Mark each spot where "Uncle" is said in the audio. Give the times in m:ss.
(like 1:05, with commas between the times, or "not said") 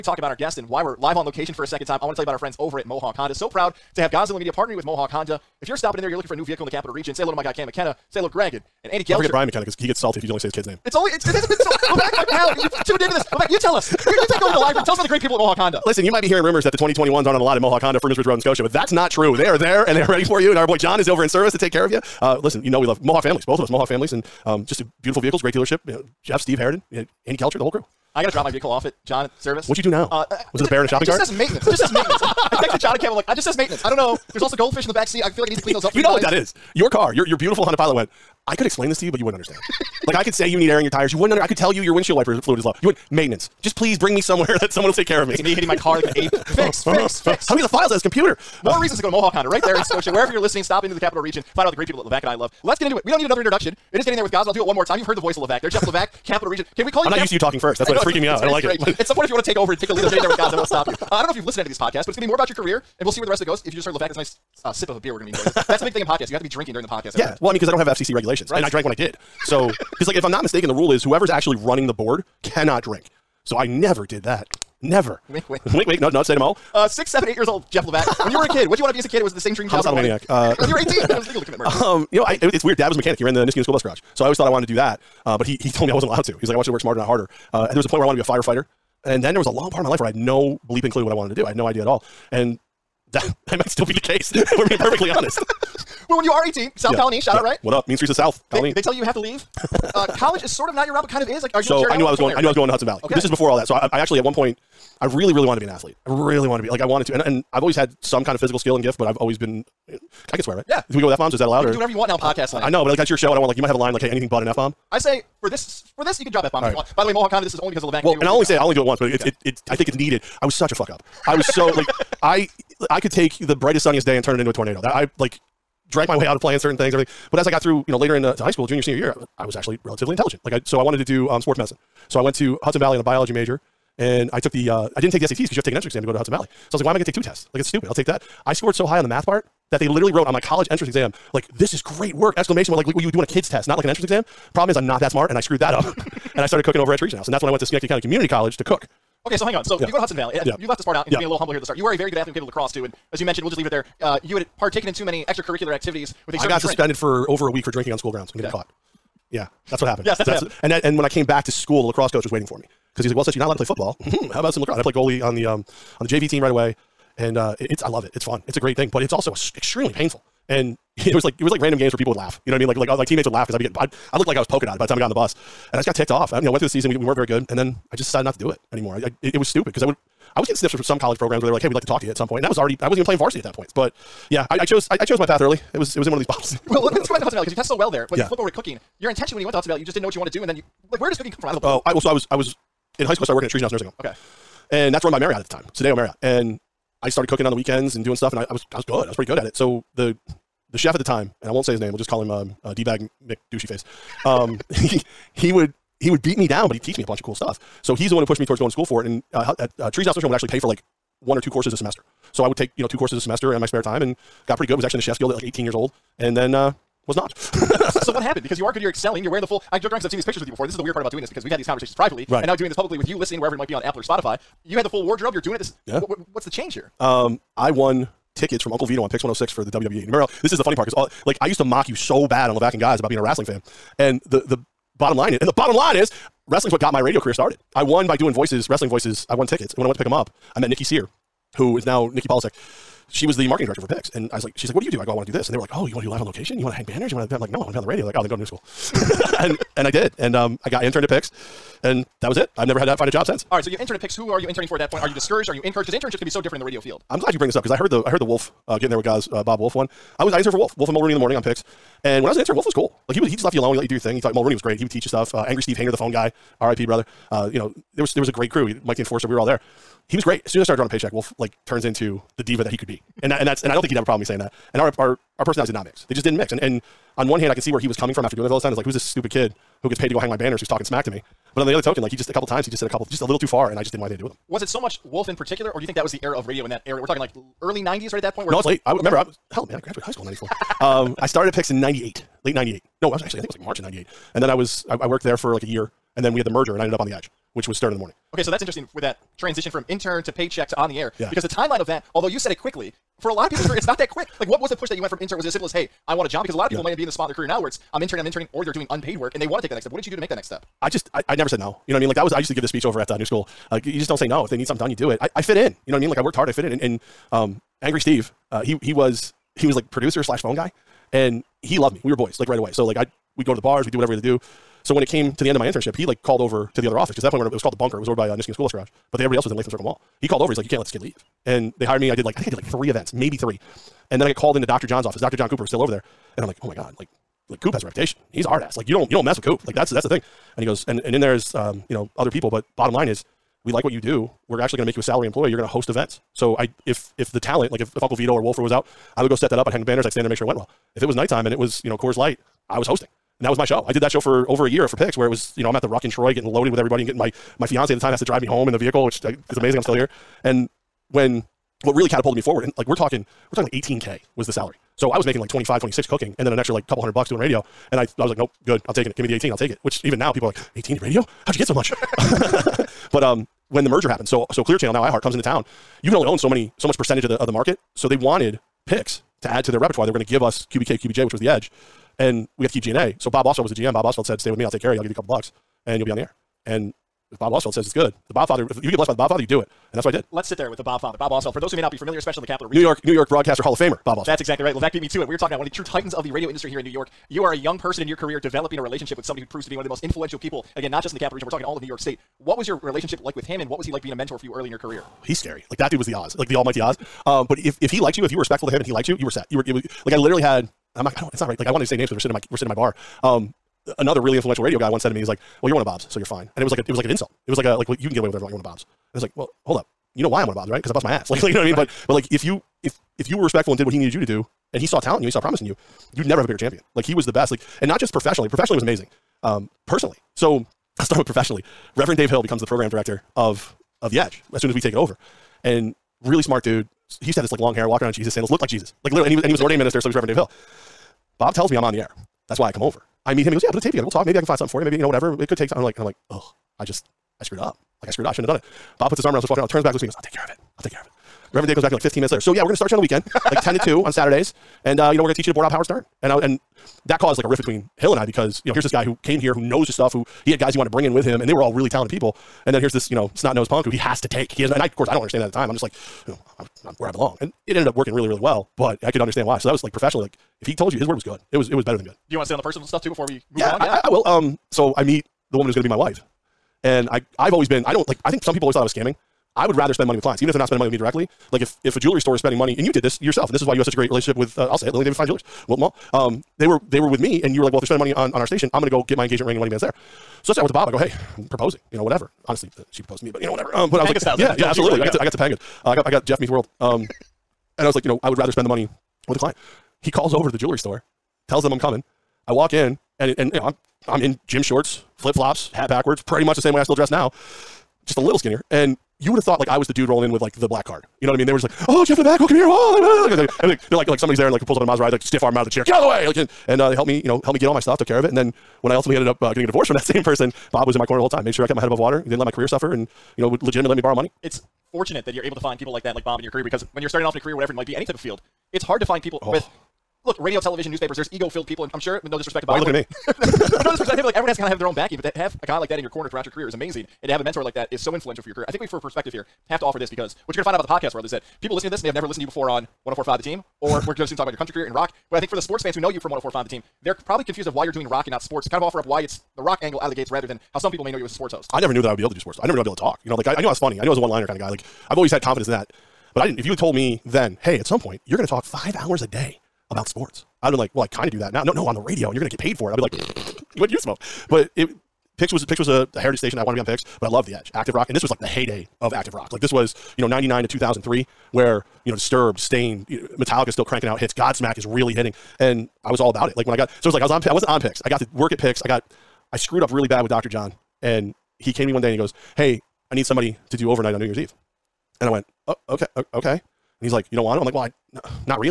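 3:48, 5:48.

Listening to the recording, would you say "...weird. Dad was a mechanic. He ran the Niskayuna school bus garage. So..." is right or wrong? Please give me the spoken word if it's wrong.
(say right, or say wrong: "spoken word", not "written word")
right.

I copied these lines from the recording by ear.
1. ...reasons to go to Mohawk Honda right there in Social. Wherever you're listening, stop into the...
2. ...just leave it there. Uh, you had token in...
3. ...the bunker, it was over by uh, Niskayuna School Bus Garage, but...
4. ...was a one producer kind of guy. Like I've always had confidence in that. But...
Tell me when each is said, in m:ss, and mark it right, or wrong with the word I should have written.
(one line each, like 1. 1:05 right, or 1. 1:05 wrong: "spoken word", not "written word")
1. 0:48 wrong: "Scotia", not "Social"
2. 2:33 wrong: "partaken", not "token"
3. 5:27 right
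4. 9:14 wrong: "liner", not "producer".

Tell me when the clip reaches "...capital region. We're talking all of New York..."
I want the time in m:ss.
6:41.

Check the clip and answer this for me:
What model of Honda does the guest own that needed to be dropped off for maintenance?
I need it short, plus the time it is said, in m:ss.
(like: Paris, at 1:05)
Honda Pilot, at 0:37.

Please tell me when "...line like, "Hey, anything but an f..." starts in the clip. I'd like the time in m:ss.
1:53.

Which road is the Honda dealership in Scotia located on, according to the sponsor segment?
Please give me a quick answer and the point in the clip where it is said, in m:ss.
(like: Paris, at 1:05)
Freeman's Bridge Road, at 0:17.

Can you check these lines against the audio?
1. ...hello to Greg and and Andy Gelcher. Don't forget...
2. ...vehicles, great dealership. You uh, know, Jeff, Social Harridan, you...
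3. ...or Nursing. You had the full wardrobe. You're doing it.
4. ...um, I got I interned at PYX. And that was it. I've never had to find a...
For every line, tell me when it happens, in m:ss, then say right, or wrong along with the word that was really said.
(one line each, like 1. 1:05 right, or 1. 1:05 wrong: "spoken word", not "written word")
1. 0:08 right
2. 0:25 wrong: "Steve", not "Social"
3. 3:43 wrong: "Spotify", not "Nursing"
4. 4:10 right.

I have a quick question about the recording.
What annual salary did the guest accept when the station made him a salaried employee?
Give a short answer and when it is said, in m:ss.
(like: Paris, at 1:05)
18K, at 6:03.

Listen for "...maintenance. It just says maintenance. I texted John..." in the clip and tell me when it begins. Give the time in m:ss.
0:31.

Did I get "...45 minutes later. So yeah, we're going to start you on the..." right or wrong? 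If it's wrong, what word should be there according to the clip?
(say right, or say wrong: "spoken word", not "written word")
wrong: "15", not "45".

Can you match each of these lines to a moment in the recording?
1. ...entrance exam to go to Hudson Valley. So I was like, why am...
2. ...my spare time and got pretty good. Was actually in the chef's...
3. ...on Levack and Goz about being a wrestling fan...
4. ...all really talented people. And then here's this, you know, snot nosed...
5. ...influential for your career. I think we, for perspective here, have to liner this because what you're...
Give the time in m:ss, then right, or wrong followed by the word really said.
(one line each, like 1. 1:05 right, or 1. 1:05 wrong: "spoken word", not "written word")
1. 2:15 right
2. 3:33 right
3. 3:52 right
4. 7:41 right
5. 8:58 wrong: "offer", not "liner".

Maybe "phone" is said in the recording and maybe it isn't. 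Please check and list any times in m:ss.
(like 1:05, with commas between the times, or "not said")
4:25, 5:20.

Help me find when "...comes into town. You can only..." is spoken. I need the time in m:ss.
6:15.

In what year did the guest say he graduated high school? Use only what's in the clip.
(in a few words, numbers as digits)
1994.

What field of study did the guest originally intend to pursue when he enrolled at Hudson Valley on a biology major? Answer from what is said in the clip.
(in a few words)
Sports medicine.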